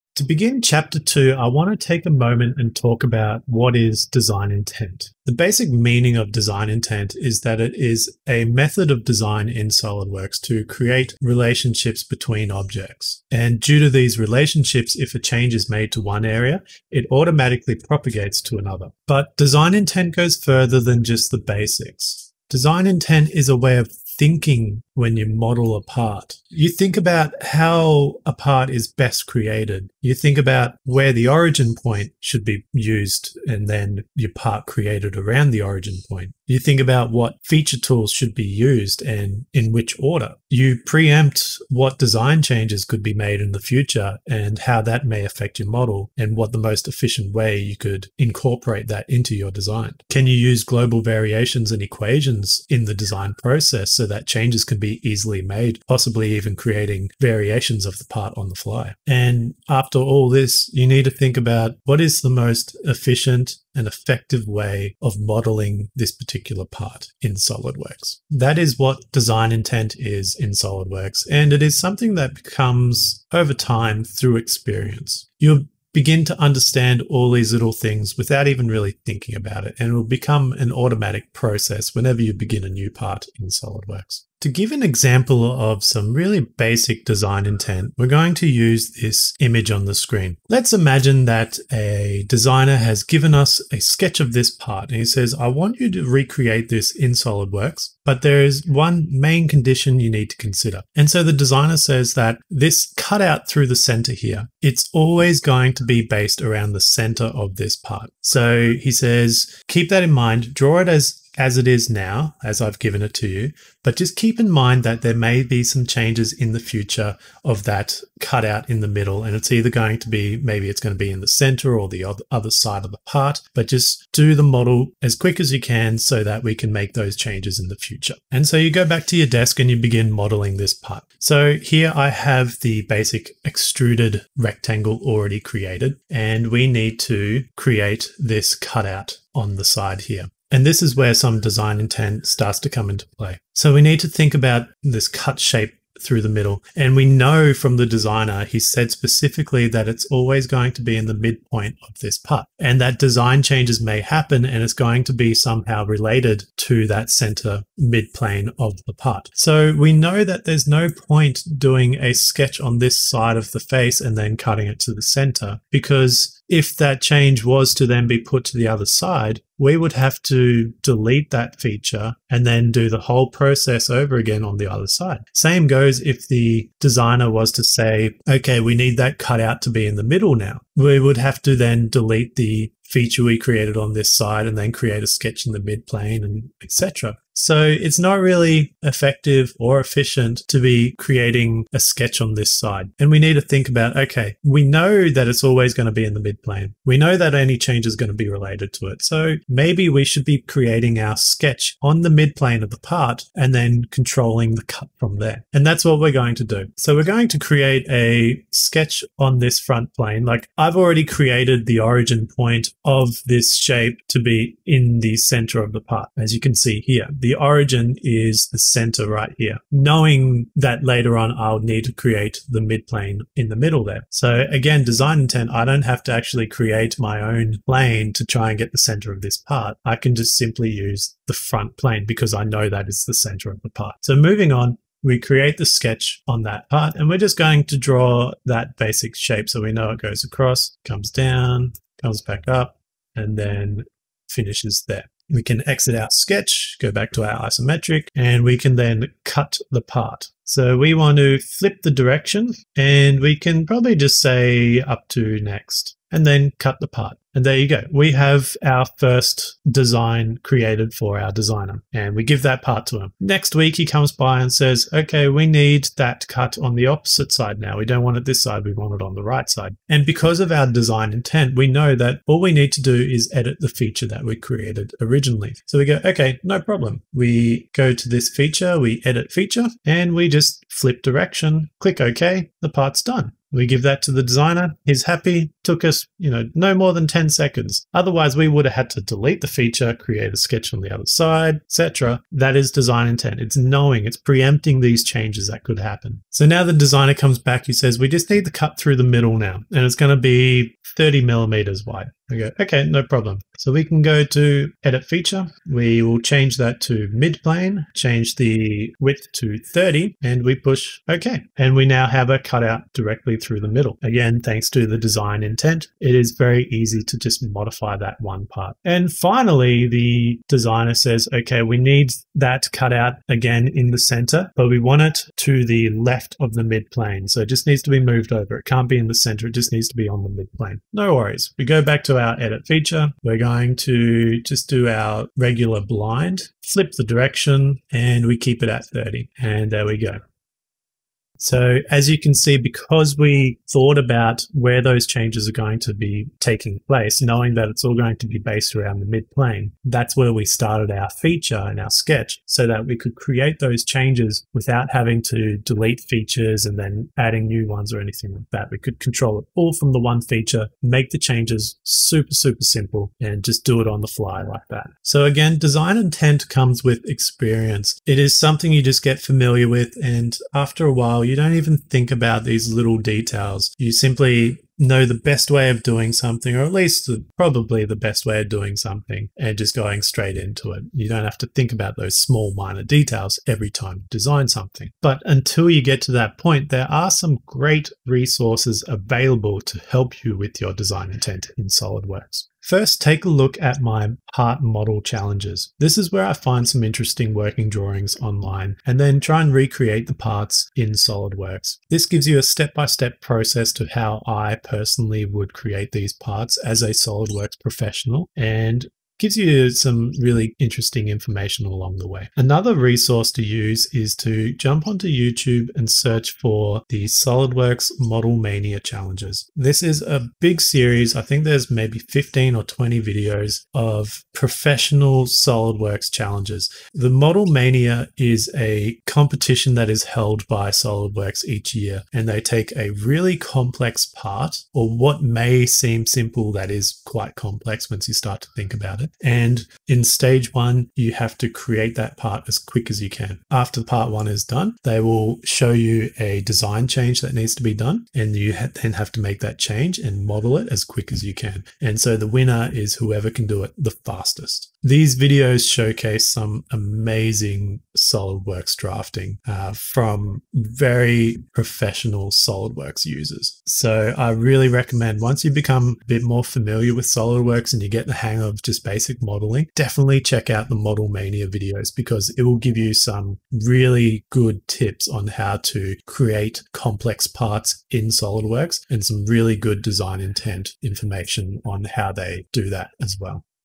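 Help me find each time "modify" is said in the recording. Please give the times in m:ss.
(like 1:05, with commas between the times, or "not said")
5:17.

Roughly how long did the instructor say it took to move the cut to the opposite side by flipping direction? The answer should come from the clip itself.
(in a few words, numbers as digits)
10 seconds.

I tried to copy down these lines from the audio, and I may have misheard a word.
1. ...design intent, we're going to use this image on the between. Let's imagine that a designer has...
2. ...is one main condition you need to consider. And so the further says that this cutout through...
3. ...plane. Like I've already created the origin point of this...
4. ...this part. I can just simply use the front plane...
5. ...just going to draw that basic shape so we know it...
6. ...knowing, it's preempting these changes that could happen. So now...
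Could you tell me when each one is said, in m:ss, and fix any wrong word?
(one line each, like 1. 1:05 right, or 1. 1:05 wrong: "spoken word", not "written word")
1. 1:27 wrong: "screen", not "between"
2. 1:38 wrong: "designer", not "further"
3. 3:29 right
4. 3:49 right
5. 3:57 right
6. 4:53 right.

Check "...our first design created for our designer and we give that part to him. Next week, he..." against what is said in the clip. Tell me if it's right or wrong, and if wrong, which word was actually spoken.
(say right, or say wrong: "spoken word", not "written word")
right.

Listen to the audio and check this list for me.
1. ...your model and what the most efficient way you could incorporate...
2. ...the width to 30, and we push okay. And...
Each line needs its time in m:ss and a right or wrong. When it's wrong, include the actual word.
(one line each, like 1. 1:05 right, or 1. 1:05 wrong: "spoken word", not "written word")
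1. 0:45 right
2. 5:08 right.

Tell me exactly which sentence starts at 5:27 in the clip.
So it just needs to be moved over.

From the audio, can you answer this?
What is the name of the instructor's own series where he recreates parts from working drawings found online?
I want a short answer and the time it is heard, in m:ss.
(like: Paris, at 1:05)
part model challenges, at 6:34.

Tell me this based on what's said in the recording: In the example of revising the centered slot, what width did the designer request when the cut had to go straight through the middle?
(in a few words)
30 millimeters.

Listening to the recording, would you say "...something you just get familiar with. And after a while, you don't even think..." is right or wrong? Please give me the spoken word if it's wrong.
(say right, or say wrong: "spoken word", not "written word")
right.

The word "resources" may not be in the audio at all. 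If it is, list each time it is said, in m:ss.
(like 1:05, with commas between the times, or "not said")
6:28, 6:52.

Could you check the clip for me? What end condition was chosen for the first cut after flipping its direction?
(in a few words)
up to next.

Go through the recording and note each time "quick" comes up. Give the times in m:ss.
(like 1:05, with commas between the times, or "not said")
2:05, 7:22, 7:30.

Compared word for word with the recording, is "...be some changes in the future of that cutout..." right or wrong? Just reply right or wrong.
right.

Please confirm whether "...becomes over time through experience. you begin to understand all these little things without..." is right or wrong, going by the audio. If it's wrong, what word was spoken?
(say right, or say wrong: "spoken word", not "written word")
right.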